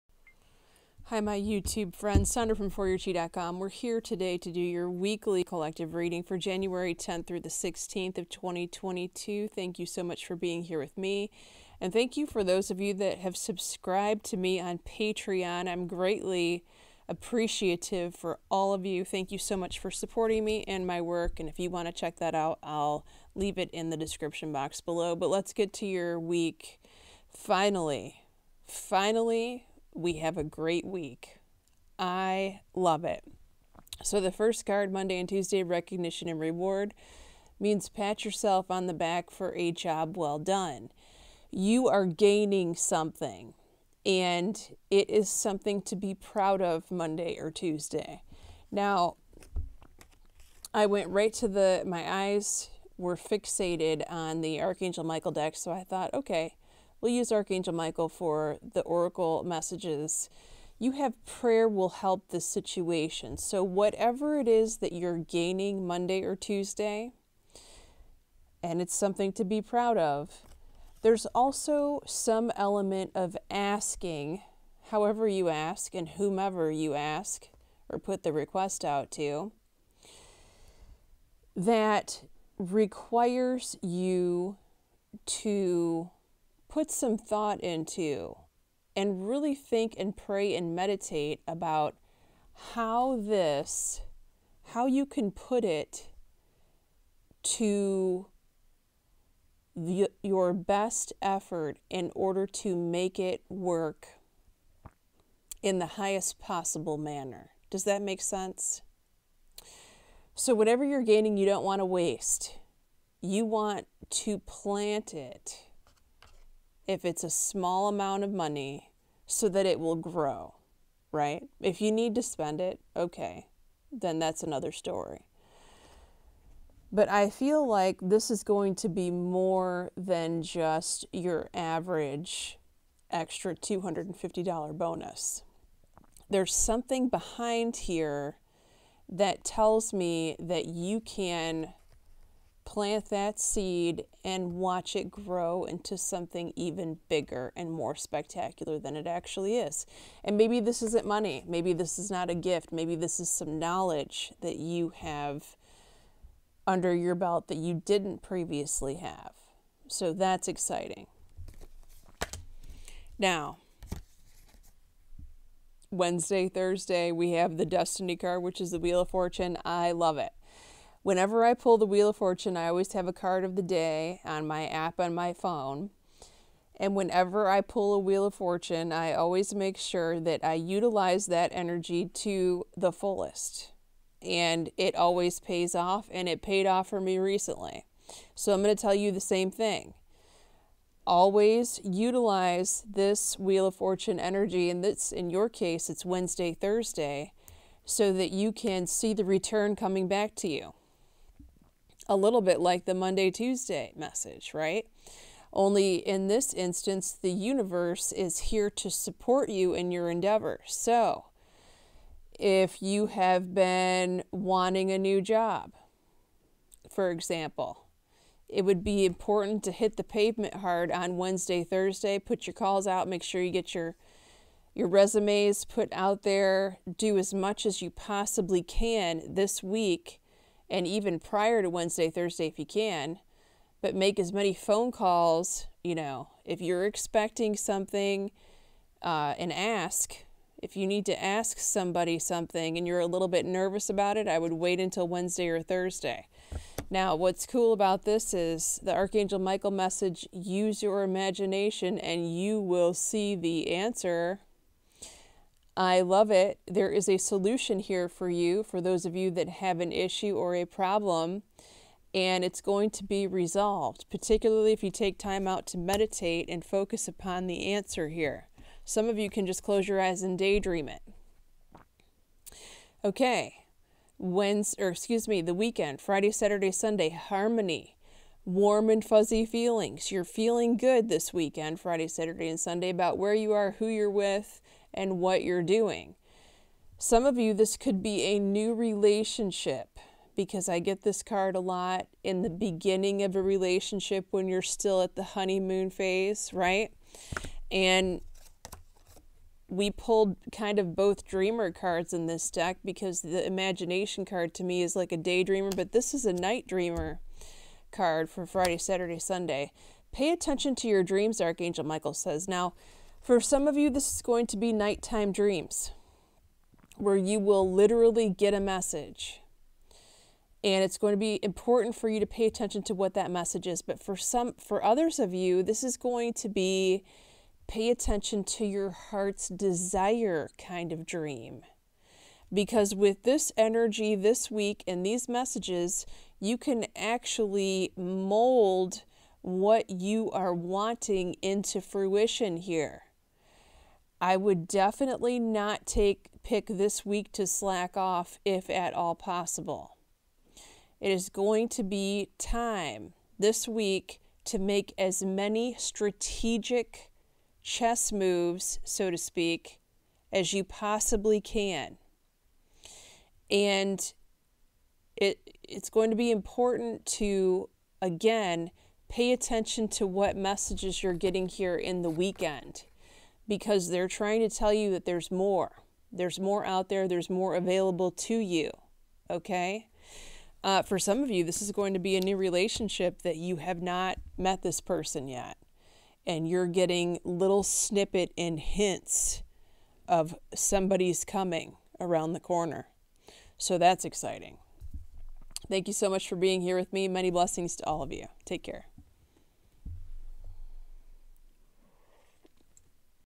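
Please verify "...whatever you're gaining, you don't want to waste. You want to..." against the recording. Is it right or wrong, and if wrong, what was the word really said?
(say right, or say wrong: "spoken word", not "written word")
right.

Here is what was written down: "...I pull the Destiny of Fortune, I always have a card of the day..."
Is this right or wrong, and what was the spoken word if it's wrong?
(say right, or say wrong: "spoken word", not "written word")
wrong: "Wheel", not "Destiny".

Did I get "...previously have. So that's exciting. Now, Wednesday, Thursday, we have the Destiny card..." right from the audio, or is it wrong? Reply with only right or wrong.
right.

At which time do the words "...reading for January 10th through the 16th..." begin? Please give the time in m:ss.
0:05.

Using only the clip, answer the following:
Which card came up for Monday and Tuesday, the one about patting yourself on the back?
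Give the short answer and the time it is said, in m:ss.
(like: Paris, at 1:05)
Recognition and reward, at 0:35.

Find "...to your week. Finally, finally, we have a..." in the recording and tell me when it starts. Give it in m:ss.
0:25.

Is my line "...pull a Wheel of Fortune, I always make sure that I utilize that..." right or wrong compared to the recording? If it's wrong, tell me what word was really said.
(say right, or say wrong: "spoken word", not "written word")
right.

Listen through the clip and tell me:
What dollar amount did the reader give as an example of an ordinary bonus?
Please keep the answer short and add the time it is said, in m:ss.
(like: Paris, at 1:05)
$250, at 2:13.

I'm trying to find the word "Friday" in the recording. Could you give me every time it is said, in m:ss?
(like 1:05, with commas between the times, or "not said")
4:36, 4:41, 5:08.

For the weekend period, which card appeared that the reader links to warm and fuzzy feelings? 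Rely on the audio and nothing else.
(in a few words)
Harmony.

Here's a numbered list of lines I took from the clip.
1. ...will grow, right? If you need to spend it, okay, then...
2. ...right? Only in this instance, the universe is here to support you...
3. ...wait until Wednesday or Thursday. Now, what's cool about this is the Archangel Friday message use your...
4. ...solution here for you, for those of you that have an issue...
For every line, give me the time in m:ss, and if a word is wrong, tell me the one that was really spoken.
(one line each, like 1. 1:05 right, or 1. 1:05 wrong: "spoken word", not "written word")
1. 1:59 right
2. 3:24 right
3. 4:04 wrong: "Michael", not "Friday"
4. 4:17 right.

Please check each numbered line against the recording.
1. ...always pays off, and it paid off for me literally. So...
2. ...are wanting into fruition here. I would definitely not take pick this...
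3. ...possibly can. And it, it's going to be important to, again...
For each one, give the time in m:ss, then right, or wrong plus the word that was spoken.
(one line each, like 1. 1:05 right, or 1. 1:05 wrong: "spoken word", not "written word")
1. 3:04 wrong: "recently", not "literally"
2. 5:40 right
3. 6:00 right.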